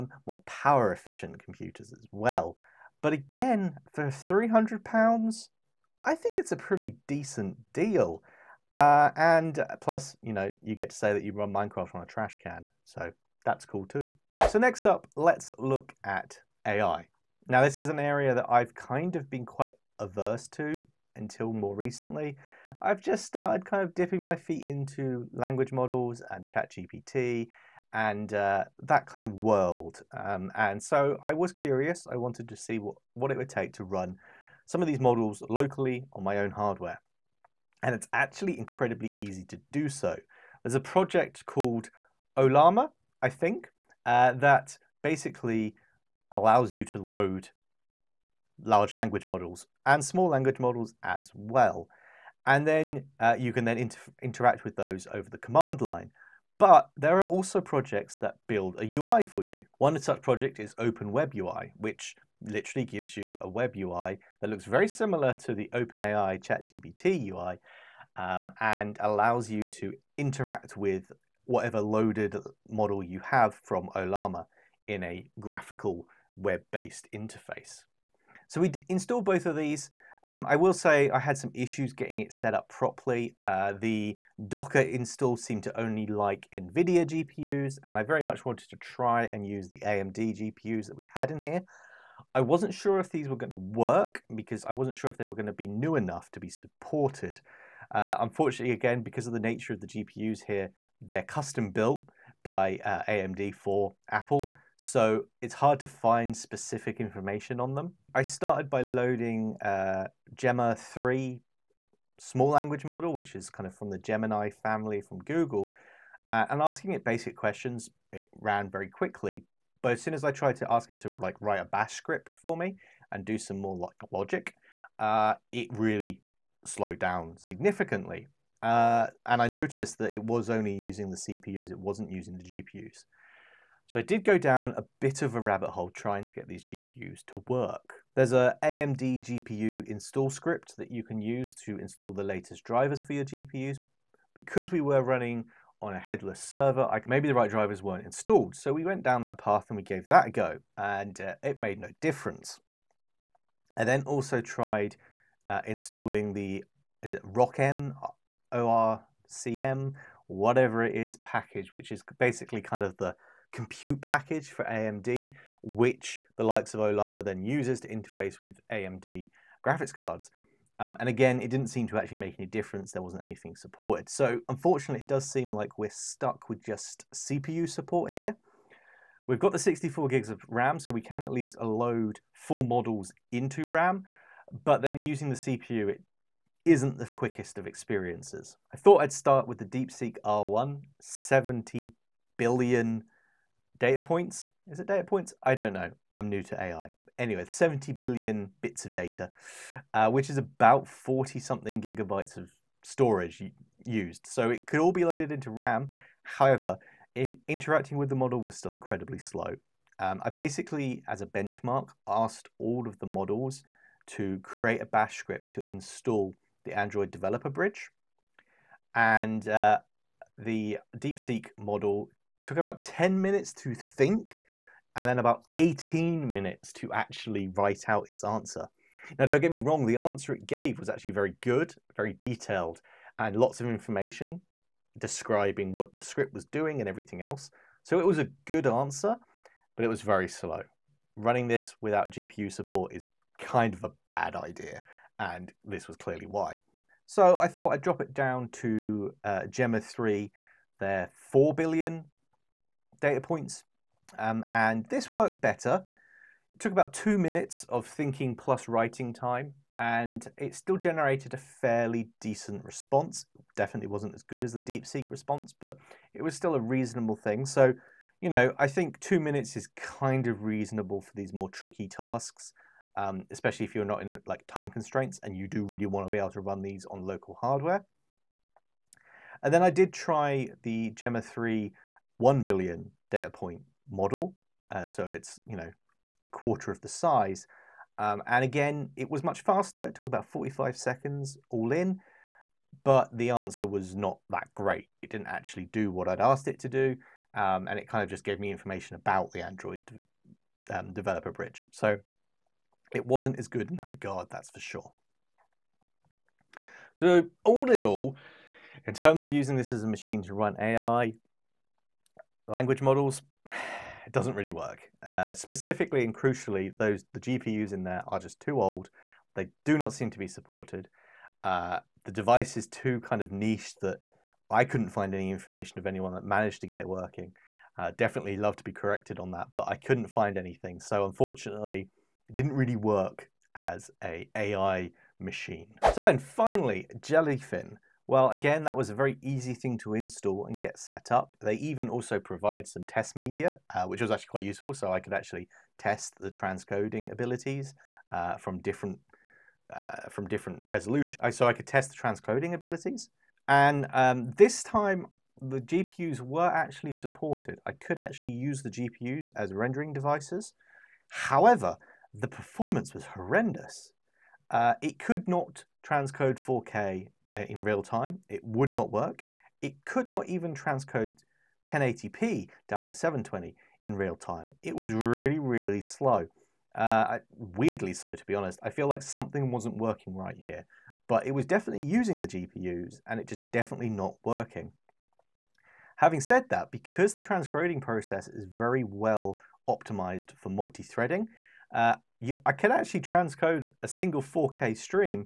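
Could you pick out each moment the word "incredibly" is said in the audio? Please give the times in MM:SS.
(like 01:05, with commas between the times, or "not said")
00:38, 03:28.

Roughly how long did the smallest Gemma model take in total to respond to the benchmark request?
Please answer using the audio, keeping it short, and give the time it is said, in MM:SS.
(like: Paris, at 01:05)
45 seconds, at 04:50.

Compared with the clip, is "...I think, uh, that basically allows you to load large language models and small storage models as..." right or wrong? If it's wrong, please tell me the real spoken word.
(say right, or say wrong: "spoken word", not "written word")
wrong: "language", not "storage".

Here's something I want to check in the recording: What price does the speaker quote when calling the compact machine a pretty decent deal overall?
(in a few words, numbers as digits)
£300.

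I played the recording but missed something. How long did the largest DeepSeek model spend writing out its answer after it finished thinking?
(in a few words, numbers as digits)
18 minutes.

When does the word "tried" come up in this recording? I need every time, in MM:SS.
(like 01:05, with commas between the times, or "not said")
02:00, 02:34.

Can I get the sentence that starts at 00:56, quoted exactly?
But there are also projects that build a UI for you.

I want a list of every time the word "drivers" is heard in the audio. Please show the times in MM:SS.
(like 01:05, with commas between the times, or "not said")
02:22, 02:27.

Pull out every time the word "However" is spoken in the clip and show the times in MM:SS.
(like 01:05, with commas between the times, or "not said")
03:26, 06:01.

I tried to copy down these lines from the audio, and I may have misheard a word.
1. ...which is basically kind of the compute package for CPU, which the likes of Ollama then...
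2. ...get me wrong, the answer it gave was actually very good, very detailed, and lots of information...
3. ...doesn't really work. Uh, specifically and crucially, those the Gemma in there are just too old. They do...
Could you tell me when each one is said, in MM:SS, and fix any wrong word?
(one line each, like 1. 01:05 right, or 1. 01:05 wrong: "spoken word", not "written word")
1. 02:41 wrong: "AMD", not "CPU"
2. 03:49 right
3. 05:14 wrong: "GPUs", not "Gemma".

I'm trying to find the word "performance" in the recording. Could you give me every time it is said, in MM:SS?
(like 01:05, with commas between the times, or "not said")
06:02.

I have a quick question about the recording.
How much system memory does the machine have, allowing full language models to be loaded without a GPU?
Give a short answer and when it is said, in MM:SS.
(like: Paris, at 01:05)
64 GB, at 02:59.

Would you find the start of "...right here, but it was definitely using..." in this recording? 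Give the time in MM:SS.
06:20.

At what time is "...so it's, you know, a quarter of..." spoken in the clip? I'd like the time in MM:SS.
04:44.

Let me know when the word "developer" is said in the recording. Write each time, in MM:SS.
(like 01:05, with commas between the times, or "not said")
03:37, 05:00.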